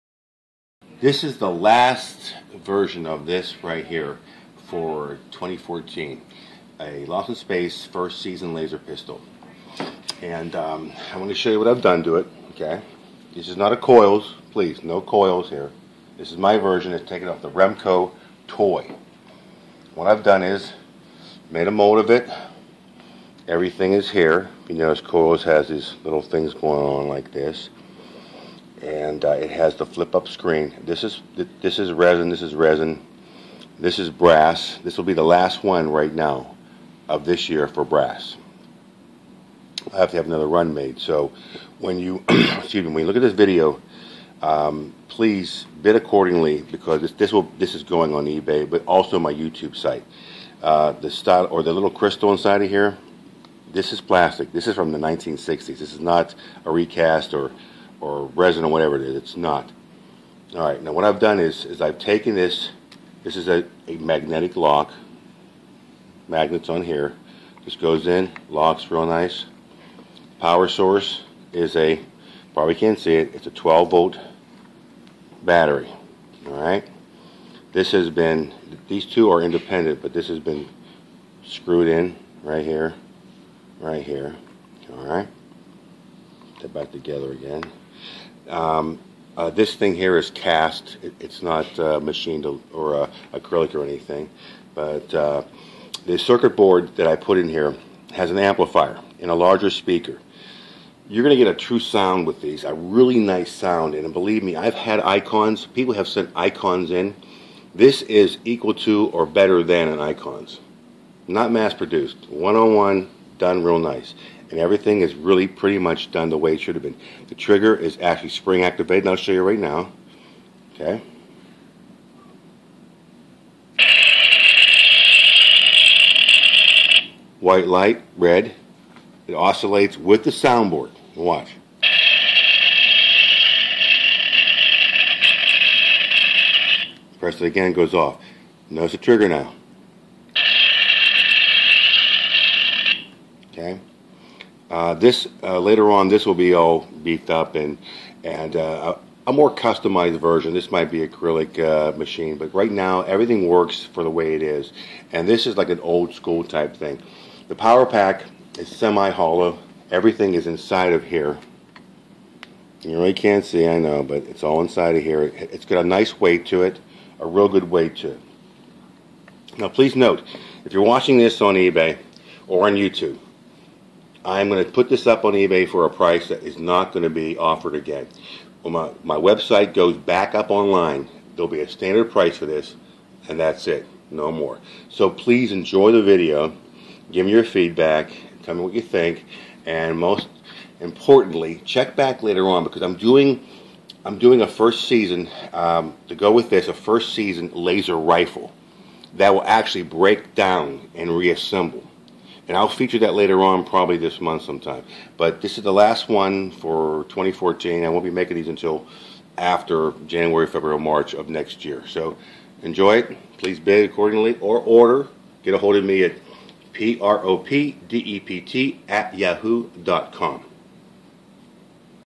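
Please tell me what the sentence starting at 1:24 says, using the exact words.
All right, put back together again.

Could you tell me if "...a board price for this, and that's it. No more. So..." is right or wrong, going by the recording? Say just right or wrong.
wrong.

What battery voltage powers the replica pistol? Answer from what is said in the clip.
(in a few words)
12 volt.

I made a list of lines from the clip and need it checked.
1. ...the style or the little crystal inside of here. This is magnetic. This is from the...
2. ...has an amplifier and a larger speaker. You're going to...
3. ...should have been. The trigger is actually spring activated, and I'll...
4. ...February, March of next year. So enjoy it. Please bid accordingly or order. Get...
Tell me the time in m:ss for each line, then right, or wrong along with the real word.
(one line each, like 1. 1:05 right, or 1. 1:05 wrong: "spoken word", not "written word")
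1. 0:50 wrong: "plastic", not "magnetic"
2. 1:38 right
3. 1:56 right
4. 3:30 right.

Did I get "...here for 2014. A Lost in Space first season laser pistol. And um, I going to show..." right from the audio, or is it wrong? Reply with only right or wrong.
right.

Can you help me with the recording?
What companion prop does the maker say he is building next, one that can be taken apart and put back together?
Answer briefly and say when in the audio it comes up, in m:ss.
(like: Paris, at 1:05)
first season laser rifle, at 3:16.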